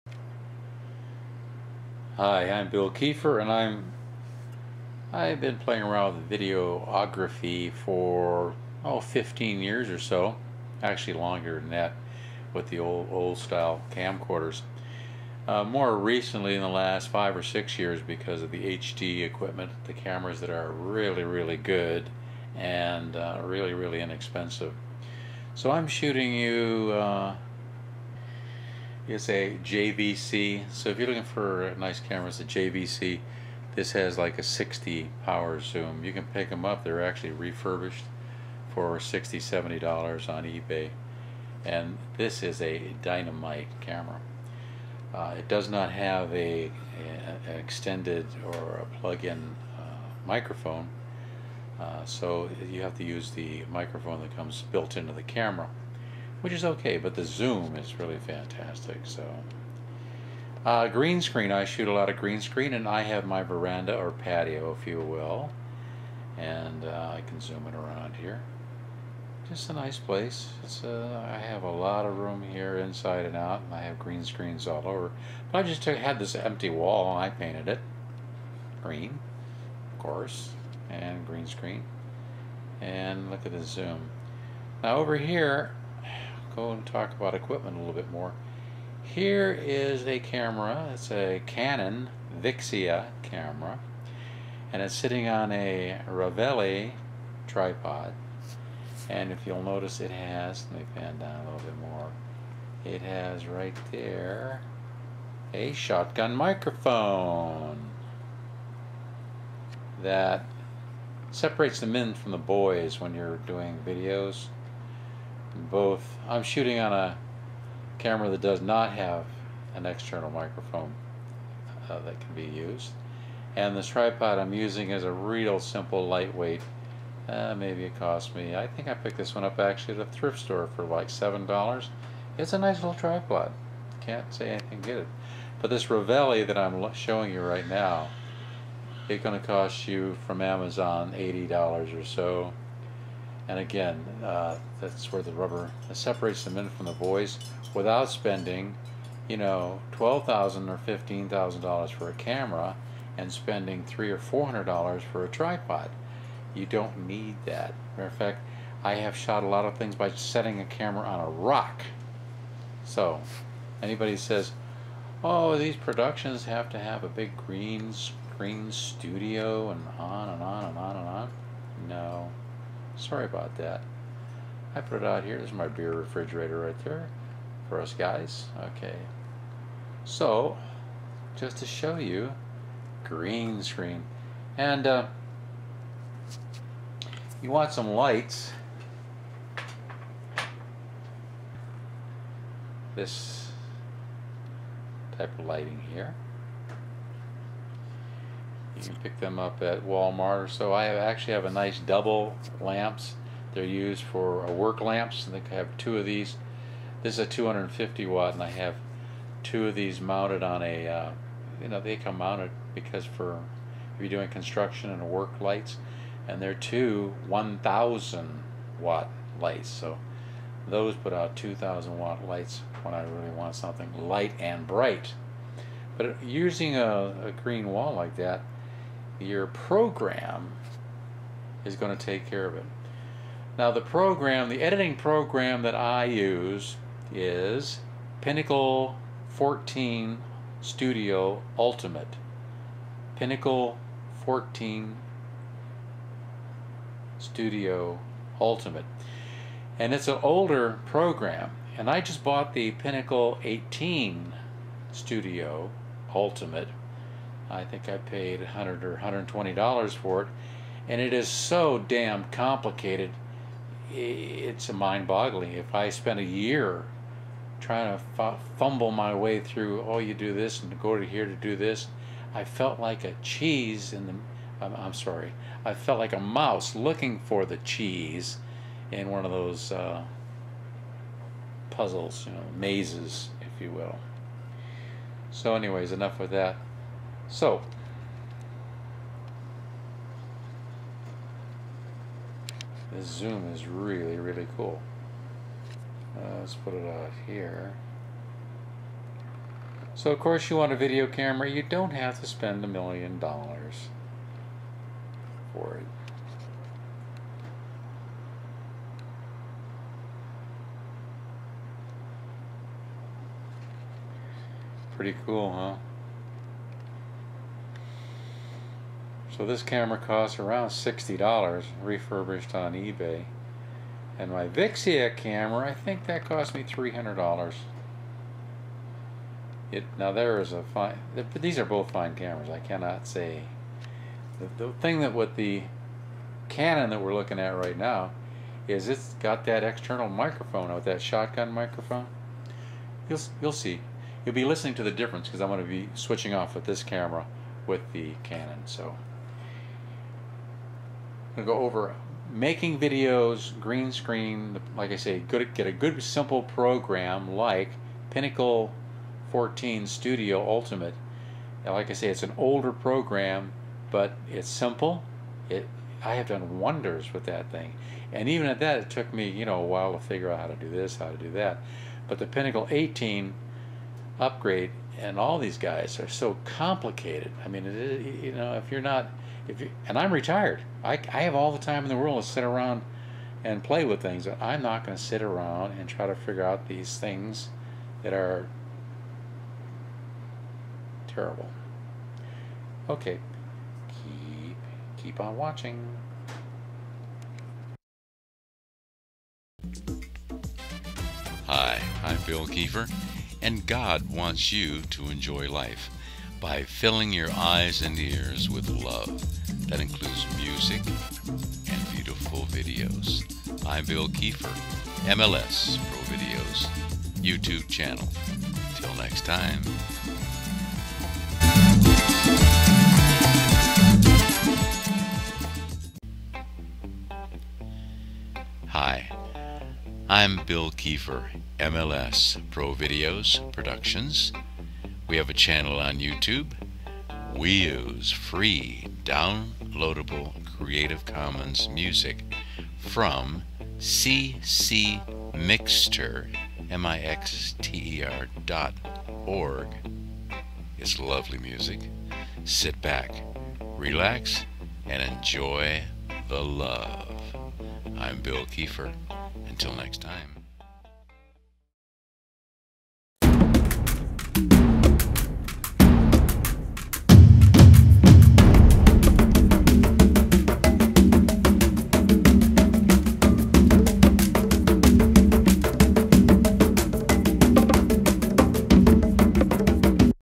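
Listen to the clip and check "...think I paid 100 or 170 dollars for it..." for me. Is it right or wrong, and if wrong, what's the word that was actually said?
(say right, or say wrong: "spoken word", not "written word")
wrong: "120", not "170".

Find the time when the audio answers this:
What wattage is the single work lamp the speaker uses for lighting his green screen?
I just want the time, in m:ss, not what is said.
3:27.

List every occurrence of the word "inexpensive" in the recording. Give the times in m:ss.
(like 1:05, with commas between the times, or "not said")
0:24.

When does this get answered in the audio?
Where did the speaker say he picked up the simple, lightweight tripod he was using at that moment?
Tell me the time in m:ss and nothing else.
2:10.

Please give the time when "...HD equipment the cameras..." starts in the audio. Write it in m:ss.
0:18.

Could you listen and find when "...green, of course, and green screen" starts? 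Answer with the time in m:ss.
1:18.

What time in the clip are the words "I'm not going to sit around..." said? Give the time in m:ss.
6:24.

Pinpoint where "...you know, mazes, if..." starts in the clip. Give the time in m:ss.
4:42.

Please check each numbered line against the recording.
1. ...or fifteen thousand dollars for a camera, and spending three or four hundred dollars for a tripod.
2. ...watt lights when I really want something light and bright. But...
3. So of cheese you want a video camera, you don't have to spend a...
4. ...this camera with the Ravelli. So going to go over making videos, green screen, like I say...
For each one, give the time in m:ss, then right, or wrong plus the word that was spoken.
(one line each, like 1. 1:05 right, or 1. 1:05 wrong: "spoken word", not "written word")
1. 2:30 right
2. 3:41 right
3. 4:59 wrong: "course", not "cheese"
4. 5:46 wrong: "Canon", not "Ravelli".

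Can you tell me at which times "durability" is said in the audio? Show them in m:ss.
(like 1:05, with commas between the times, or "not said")
not said.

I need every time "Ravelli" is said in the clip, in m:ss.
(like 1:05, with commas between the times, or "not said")
1:36, 2:15.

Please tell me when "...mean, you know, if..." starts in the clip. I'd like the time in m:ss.
6:17.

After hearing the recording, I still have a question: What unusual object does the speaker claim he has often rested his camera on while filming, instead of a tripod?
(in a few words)
a rock.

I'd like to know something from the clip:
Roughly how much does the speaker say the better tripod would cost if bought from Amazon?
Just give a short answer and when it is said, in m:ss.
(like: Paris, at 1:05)
$80, at 2:21.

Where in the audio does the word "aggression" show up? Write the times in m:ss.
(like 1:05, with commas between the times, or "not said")
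not said.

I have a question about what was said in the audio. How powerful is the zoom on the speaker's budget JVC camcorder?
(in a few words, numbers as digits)
60 power.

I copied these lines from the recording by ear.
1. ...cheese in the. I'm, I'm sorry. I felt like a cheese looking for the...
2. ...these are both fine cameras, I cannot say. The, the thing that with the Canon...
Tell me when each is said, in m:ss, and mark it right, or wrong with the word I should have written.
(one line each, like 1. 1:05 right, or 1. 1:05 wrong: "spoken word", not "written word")
1. 4:33 wrong: "mouse", not "cheese"
2. 5:31 right.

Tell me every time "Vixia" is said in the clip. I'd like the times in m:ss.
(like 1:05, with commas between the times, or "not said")
1:32, 5:24.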